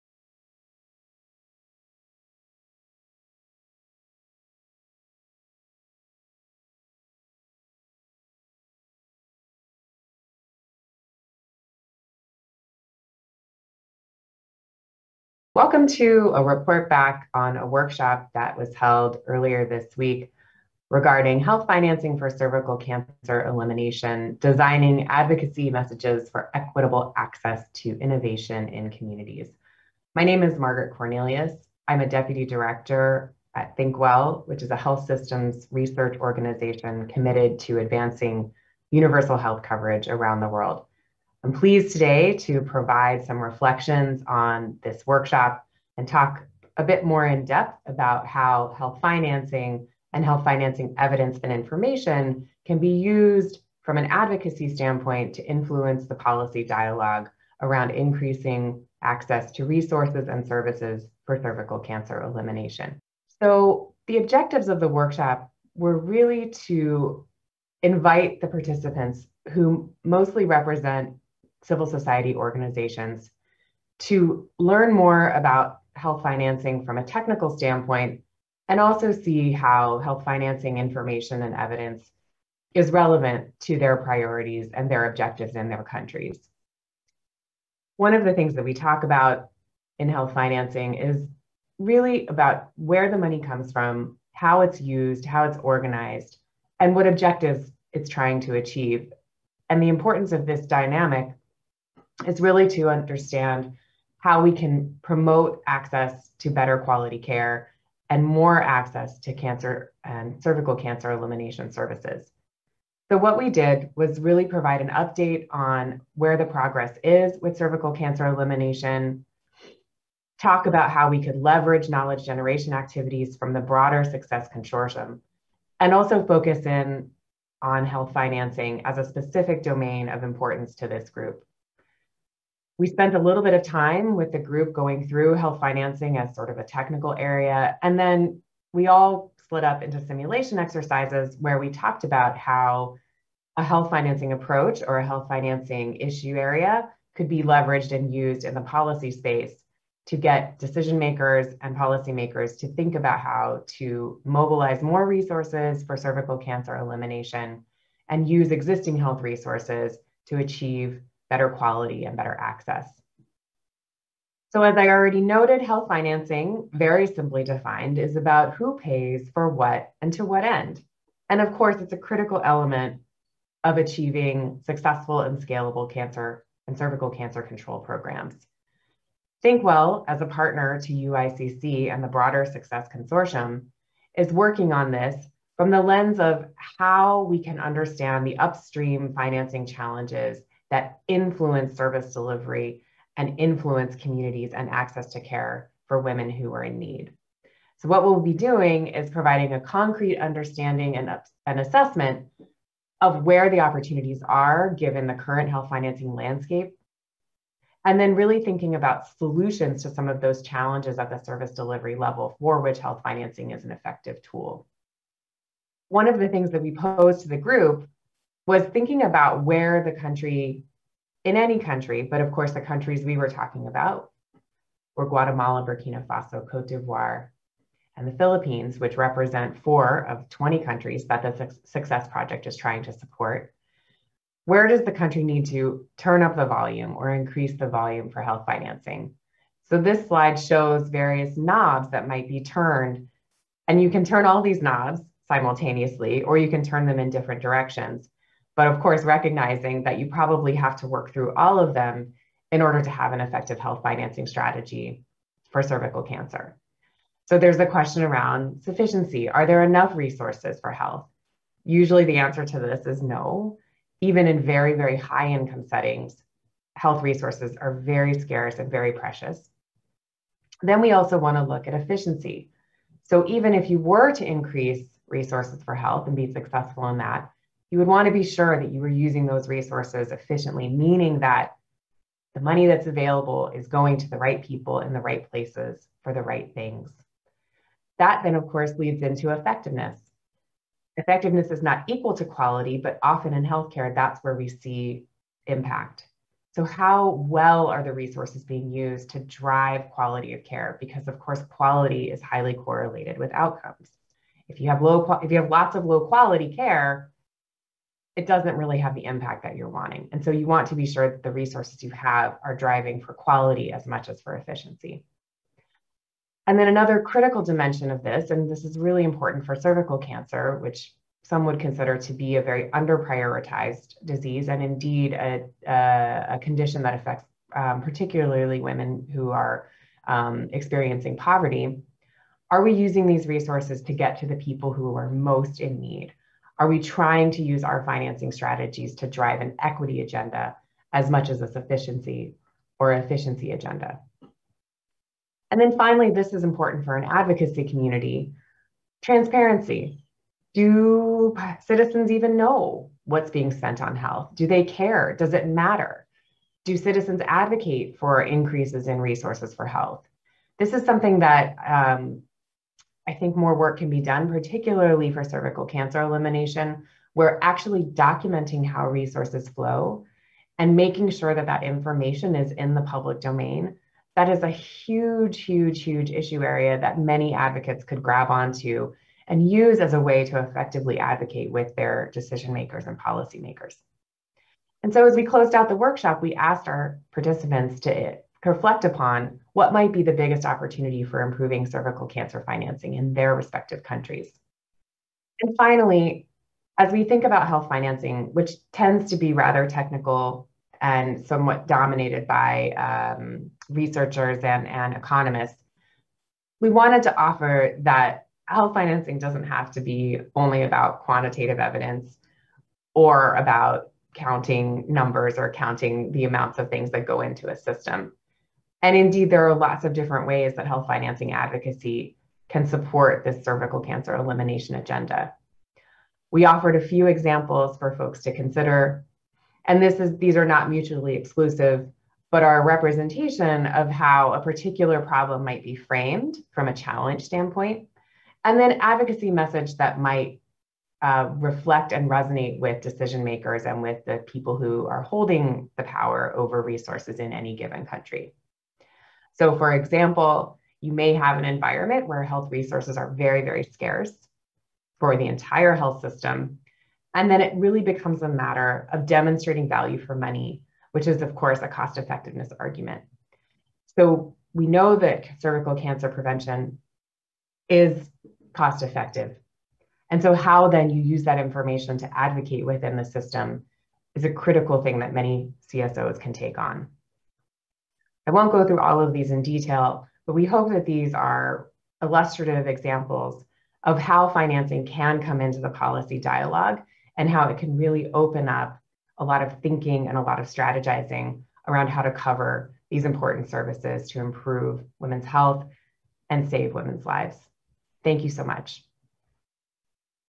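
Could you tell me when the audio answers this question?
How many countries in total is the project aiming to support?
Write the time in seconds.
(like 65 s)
230 s.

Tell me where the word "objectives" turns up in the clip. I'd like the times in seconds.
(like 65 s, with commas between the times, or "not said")
64 s, 85 s, 97 s.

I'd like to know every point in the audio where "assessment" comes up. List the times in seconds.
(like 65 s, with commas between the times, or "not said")
201 s.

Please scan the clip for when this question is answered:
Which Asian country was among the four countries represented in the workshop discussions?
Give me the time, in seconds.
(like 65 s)
228 s.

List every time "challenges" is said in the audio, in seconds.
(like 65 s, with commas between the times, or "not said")
189 s, 210 s, 436 s.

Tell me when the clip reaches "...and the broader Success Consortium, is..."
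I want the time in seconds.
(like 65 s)
181 s.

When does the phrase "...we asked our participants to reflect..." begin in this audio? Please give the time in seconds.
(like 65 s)
386 s.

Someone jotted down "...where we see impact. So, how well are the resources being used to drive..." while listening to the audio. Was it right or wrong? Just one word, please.
right.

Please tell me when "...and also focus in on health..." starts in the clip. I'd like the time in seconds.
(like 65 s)
125 s.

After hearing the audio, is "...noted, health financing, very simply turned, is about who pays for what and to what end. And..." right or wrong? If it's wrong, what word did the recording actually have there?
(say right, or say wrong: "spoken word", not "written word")
wrong: "defined", not "turned".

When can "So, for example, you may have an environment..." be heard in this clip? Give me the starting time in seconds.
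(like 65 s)
449 s.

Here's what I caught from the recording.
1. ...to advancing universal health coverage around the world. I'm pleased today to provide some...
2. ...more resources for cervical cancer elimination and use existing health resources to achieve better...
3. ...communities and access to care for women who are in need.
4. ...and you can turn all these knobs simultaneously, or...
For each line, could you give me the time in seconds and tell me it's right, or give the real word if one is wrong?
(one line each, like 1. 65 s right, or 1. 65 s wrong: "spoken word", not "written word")
1. 37 s right
2. 154 s right
3. 193 s right
4. 243 s right.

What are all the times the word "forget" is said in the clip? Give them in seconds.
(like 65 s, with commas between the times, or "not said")
not said.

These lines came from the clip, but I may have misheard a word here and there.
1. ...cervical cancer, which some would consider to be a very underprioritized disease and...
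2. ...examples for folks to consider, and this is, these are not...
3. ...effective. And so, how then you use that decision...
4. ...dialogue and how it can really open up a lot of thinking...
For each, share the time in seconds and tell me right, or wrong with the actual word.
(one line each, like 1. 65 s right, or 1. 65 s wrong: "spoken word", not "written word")
1. 319 s right
2. 427 s right
3. 468 s wrong: "information", not "decision"
4. 486 s right.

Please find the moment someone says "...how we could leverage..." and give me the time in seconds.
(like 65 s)
120 s.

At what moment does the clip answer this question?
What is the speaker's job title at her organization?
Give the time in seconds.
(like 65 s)
32 s.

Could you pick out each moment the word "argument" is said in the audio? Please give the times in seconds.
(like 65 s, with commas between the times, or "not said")
462 s.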